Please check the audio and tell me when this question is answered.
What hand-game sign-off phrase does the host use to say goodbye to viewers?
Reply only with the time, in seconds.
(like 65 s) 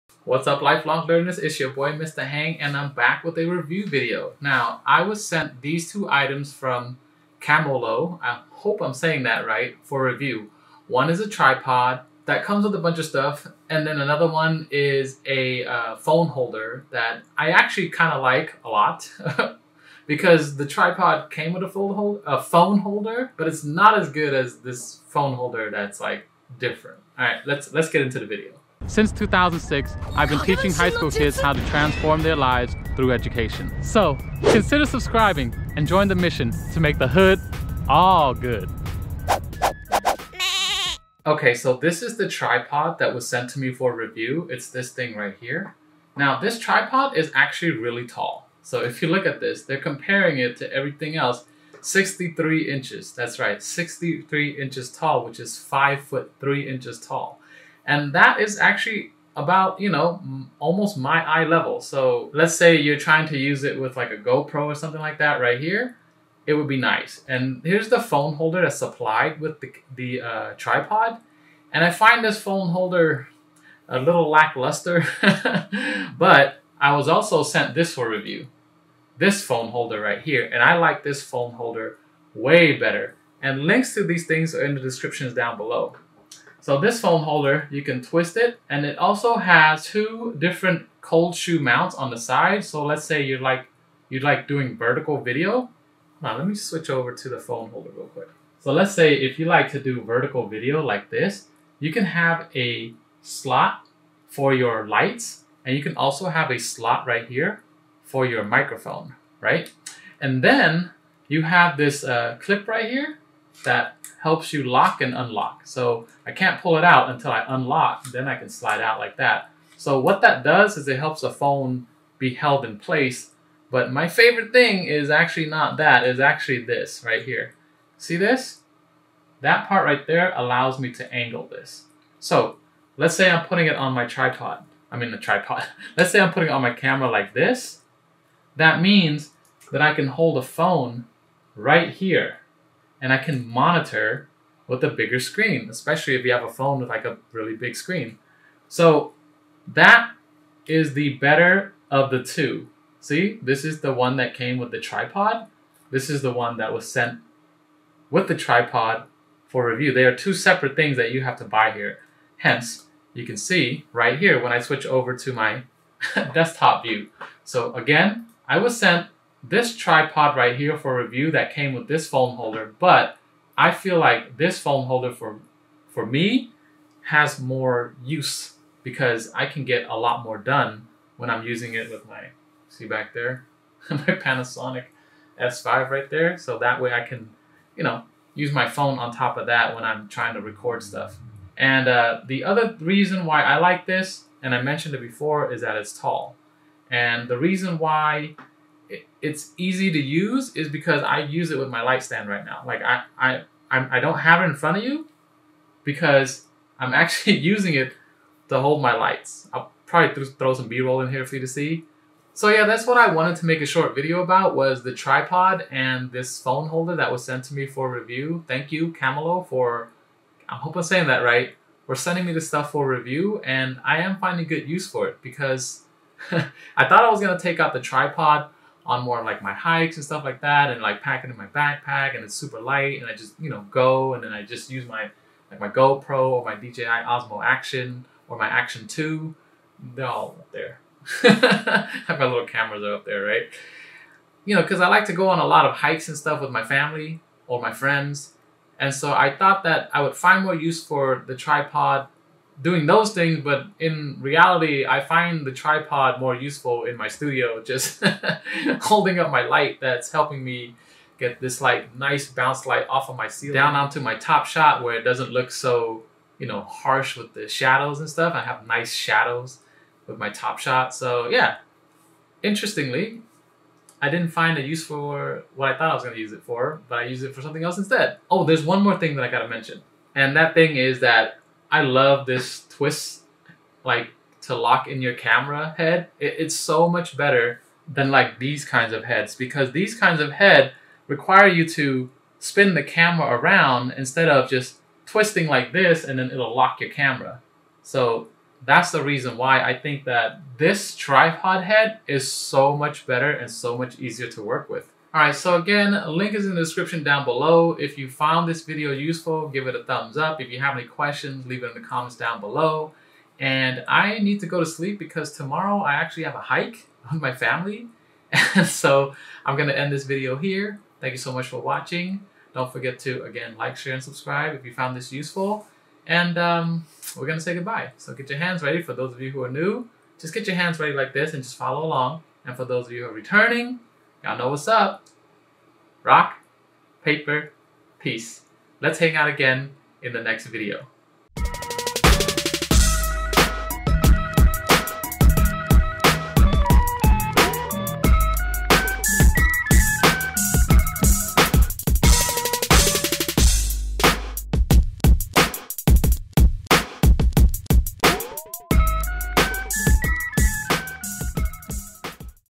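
336 s.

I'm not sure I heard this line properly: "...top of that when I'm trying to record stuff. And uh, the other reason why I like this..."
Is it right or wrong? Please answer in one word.
right.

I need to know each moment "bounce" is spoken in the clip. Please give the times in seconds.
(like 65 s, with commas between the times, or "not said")
262 s.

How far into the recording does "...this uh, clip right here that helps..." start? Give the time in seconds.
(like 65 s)
111 s.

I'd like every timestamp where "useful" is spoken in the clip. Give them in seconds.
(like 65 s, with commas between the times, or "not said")
256 s, 308 s, 325 s.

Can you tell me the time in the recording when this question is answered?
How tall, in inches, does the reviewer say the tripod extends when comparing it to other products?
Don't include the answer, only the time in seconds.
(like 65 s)
53 s.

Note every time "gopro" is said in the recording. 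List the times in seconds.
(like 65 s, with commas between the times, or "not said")
64 s, 235 s.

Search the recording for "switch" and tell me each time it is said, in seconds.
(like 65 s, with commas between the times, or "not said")
96 s, 164 s.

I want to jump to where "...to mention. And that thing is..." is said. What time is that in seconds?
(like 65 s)
279 s.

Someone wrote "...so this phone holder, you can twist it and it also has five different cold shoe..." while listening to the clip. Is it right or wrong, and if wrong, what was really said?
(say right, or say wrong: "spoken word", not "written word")
wrong: "two", not "five".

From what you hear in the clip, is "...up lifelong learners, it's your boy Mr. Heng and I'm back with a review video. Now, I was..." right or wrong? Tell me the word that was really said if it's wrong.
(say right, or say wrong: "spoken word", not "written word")
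right.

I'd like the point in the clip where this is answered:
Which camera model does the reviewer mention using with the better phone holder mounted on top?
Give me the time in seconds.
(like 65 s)
183 s.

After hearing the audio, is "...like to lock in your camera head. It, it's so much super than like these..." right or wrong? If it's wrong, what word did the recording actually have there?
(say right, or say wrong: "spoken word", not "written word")
wrong: "better", not "super".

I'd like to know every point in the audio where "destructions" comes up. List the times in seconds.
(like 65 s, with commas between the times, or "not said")
not said.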